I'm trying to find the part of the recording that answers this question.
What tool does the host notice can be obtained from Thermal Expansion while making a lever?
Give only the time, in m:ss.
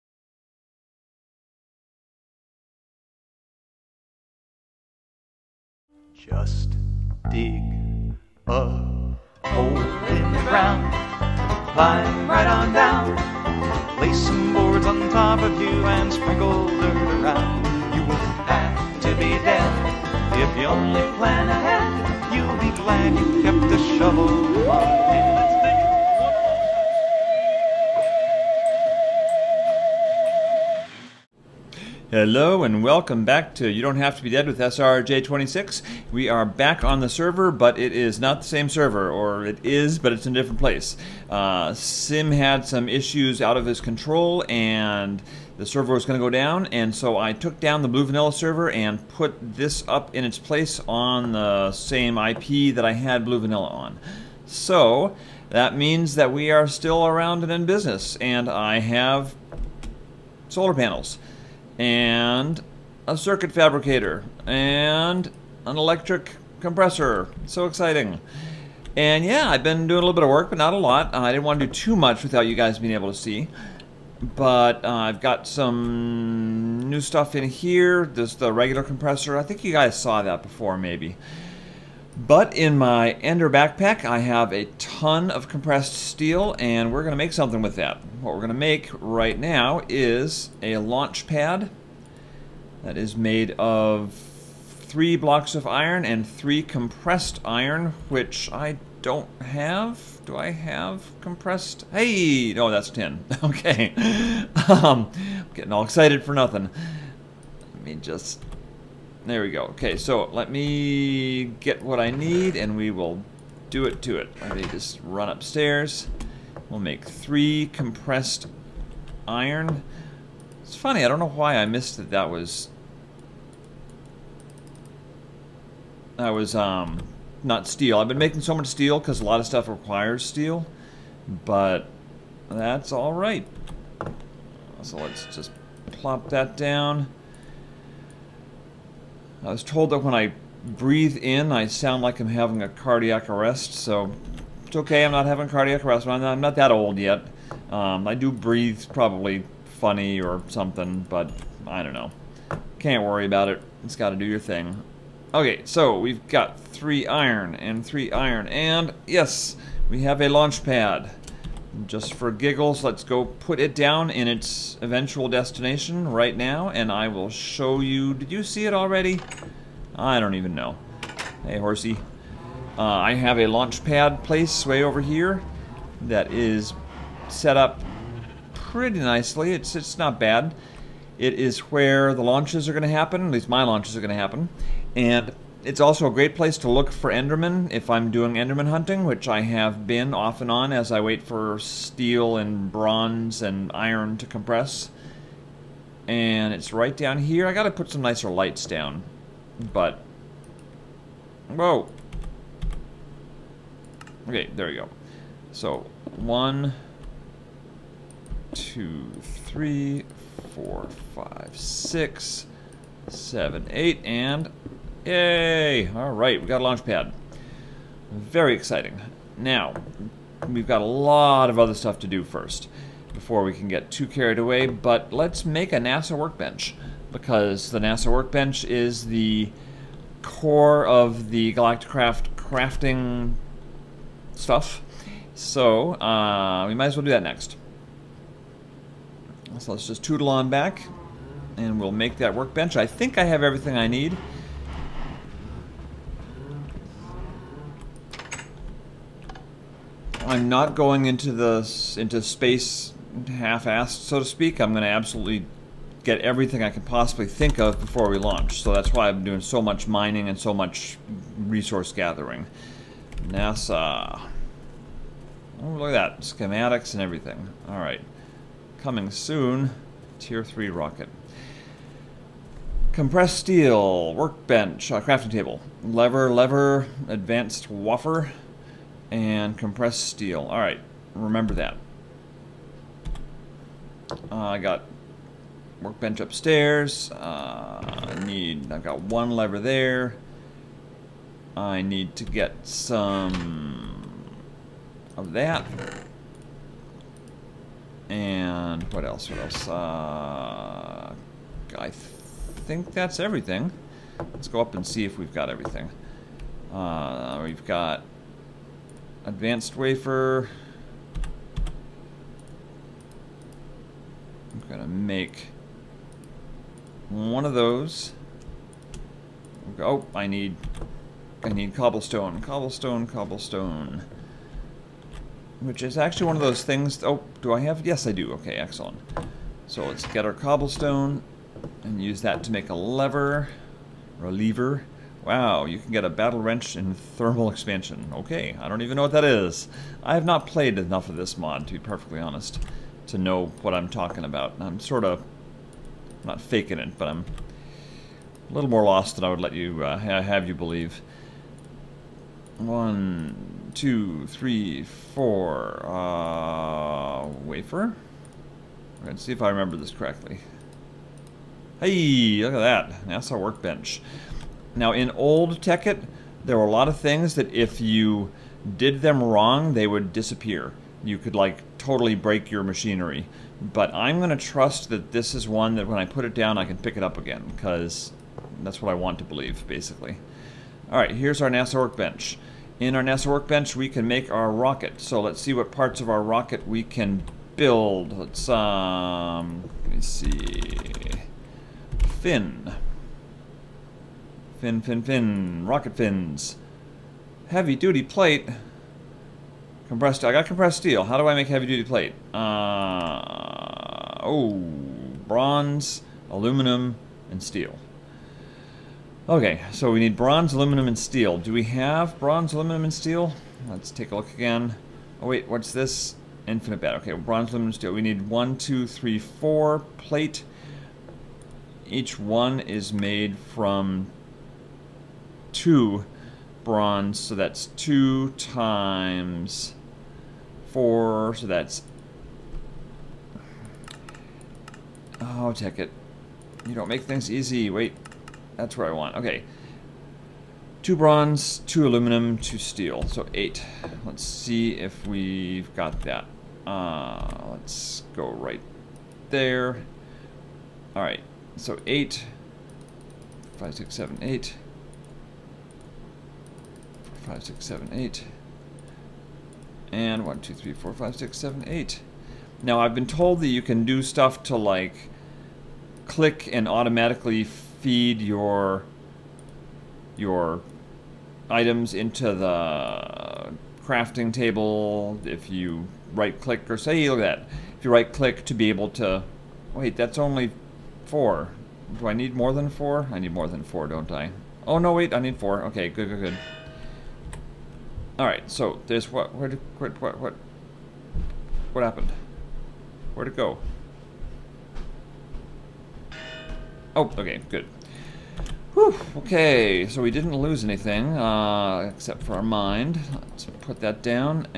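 5:36.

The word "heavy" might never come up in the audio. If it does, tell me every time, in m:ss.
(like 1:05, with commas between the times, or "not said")
6:37, 6:41.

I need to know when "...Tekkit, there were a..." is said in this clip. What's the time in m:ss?
6:05.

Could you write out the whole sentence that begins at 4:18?
So that's why I'm doing so much mining and so much resource gathering.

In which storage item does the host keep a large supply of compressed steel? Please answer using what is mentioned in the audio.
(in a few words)
Ender backpack.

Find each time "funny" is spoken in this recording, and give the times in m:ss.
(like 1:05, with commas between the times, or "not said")
2:00, 2:29.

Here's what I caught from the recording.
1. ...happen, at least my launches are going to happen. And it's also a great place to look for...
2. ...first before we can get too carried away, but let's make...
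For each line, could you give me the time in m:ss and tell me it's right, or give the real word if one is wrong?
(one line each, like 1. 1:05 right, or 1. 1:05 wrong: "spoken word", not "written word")
1. 3:02 right
2. 3:42 right.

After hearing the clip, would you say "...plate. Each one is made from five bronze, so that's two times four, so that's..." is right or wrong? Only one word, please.
wrong.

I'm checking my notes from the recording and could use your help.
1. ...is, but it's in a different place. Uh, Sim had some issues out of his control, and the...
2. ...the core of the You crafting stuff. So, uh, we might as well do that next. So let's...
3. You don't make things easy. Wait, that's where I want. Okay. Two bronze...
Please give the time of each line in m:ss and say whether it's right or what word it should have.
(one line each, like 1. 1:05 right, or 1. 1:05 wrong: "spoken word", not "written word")
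1. 0:39 right
2. 3:49 wrong: "Galacticraft", not "You"
3. 7:16 right.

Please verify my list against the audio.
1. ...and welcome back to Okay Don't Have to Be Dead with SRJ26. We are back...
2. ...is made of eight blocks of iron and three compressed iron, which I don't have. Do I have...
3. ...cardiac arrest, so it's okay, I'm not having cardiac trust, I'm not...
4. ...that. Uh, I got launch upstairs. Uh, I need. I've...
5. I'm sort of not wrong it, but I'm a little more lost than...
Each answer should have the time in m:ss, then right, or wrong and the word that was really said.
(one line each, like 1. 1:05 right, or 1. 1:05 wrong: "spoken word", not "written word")
1. 0:32 wrong: "You", not "Okay"
2. 1:32 wrong: "three", not "eight"
3. 2:22 wrong: "arrest", not "trust"
4. 4:41 wrong: "workbench", not "launch"
5. 5:44 wrong: "faking", not "wrong".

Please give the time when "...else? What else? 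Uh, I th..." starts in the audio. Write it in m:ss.
4:59.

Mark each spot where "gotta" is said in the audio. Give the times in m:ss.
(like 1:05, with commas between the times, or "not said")
2:33, 3:17.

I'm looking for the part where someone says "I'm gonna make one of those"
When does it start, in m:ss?
5:14.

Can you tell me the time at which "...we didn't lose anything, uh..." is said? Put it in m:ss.
8:20.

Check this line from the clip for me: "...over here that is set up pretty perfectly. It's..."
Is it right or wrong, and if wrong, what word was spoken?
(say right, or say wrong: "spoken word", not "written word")
wrong: "nicely", not "perfectly".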